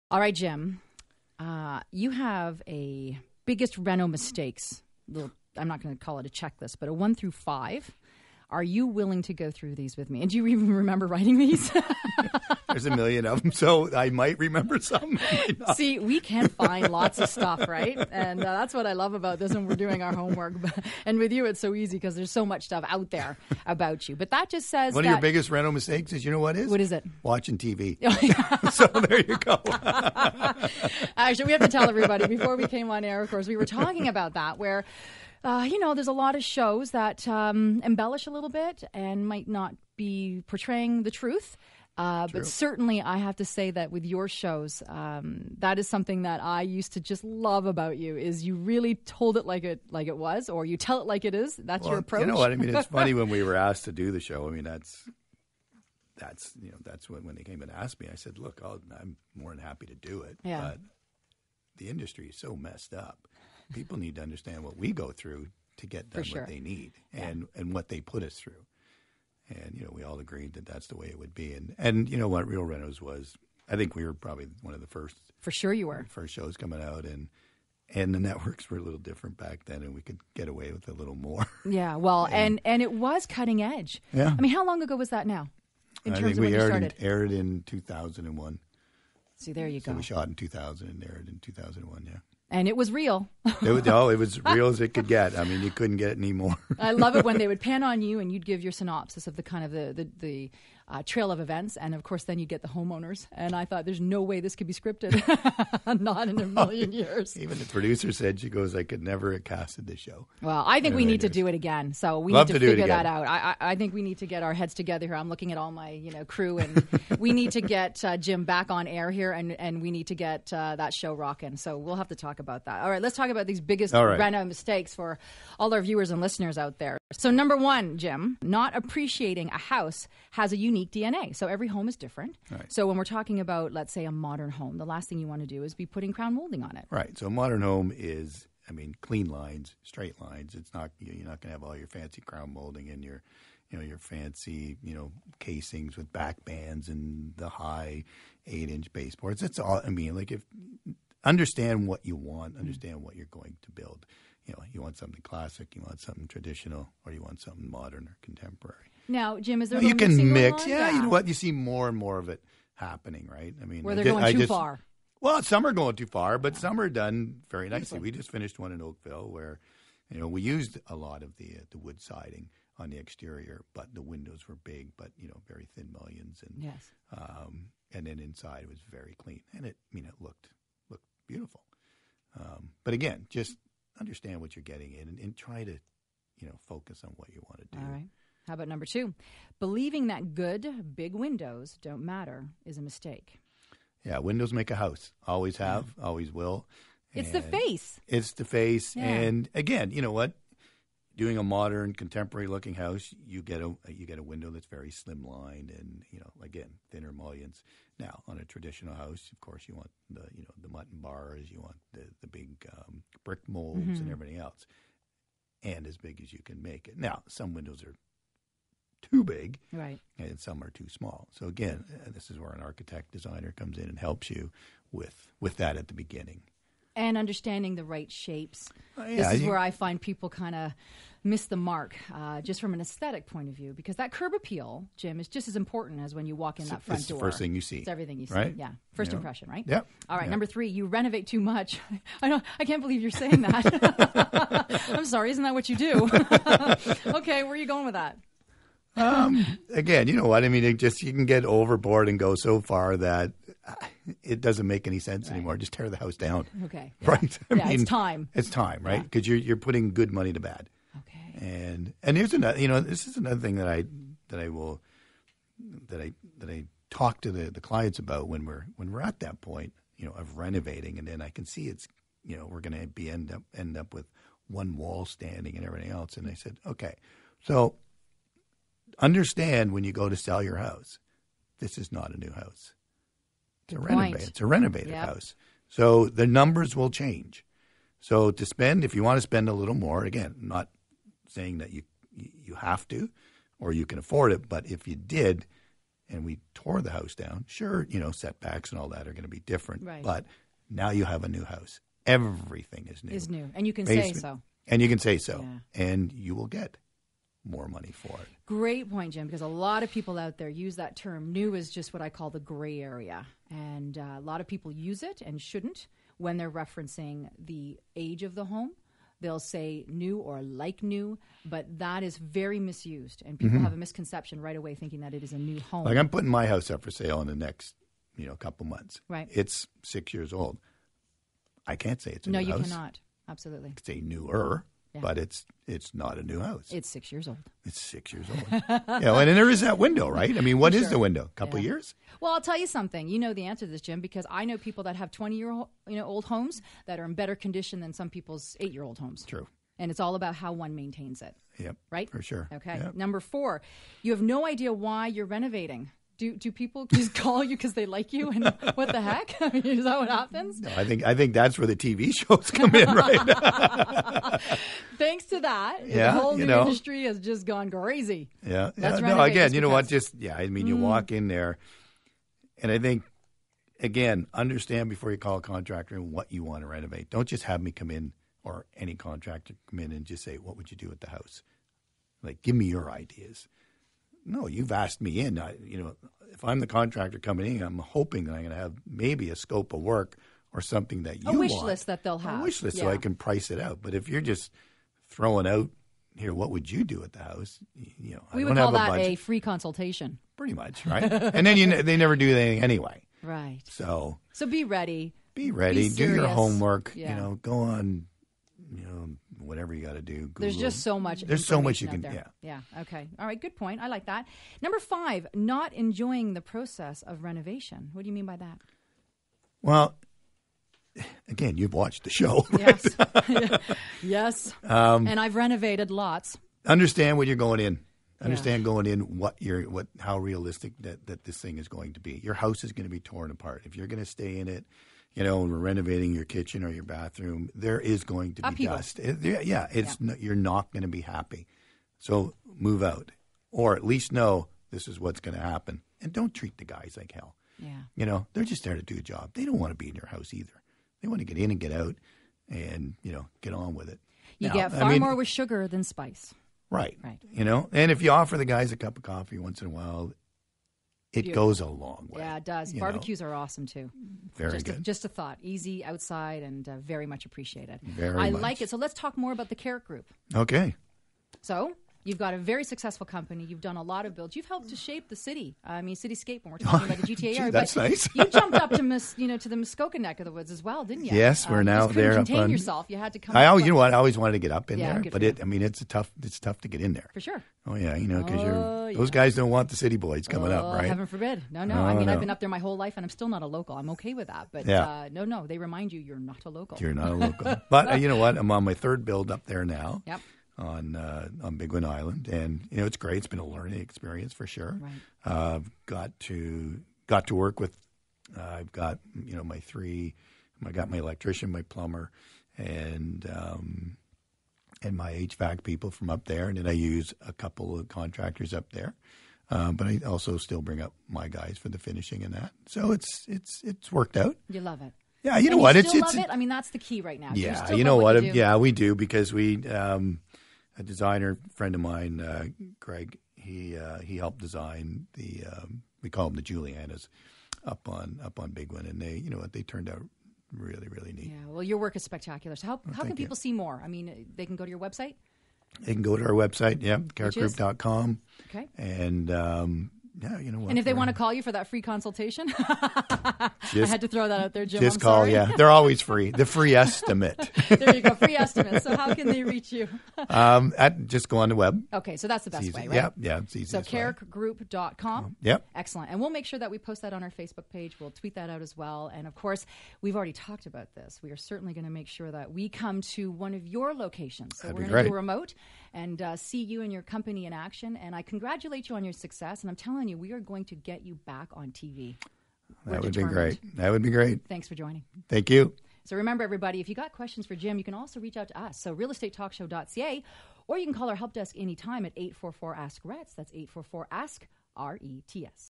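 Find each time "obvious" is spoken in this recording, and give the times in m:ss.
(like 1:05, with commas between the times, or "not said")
not said.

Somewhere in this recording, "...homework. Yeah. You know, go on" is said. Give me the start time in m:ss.
6:46.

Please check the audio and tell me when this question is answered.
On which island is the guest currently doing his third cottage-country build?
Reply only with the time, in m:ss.
8:21.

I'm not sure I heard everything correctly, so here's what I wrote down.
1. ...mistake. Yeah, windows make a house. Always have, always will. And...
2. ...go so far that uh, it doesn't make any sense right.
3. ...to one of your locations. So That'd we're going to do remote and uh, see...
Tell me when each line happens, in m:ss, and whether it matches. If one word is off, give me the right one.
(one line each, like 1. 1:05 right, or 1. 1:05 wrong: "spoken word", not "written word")
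1. 3:12 right
2. 4:12 right
3. 9:33 right.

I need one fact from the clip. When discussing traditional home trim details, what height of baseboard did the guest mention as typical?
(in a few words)
8 inch.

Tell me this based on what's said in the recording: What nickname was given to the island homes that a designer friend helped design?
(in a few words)
the Julianas.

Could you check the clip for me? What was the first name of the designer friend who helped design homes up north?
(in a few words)
Greg.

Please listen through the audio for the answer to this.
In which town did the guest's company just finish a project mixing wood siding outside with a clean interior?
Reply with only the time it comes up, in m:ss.
2:48.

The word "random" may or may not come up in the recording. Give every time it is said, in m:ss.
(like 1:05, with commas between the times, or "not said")
2:04.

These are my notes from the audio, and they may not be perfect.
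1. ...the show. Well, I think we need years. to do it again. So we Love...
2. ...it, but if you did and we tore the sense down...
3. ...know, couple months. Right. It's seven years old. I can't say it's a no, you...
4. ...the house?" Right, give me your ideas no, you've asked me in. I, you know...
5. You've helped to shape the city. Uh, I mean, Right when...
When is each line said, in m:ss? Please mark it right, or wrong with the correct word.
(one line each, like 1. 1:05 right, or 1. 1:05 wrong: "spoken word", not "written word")
1. 1:49 right
2. 4:54 wrong: "house", not "sense"
3. 5:28 wrong: "six", not "seven"
4. 6:20 wrong: "Like", not "Right"
5. 7:54 wrong: "Cityscape", not "Right".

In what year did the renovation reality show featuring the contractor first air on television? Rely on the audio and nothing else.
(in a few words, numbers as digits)
2001.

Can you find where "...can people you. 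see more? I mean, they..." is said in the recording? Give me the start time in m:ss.
9:03.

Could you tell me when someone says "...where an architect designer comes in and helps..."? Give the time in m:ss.
3:42.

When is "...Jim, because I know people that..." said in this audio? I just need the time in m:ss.
5:43.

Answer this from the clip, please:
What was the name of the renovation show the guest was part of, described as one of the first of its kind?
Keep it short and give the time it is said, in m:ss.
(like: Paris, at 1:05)
Real Renos, at 1:12.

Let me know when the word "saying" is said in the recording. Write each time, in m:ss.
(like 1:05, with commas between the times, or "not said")
4:03, 4:51.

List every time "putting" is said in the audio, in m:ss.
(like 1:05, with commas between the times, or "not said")
2:15, 4:19, 5:26.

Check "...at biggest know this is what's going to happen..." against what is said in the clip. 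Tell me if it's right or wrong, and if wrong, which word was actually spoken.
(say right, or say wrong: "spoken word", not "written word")
wrong: "least", not "biggest".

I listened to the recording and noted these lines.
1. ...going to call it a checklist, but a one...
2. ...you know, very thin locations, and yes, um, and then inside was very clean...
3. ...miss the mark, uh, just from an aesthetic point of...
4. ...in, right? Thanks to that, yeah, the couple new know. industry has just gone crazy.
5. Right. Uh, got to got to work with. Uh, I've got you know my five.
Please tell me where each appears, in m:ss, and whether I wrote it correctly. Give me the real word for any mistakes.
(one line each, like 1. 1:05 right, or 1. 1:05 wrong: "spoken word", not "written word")
1. 0:05 right
2. 2:55 wrong: "mullions", not "locations"
3. 3:51 right
4. 6:02 wrong: "whole", not "couple"
5. 8:24 wrong: "three", not "five".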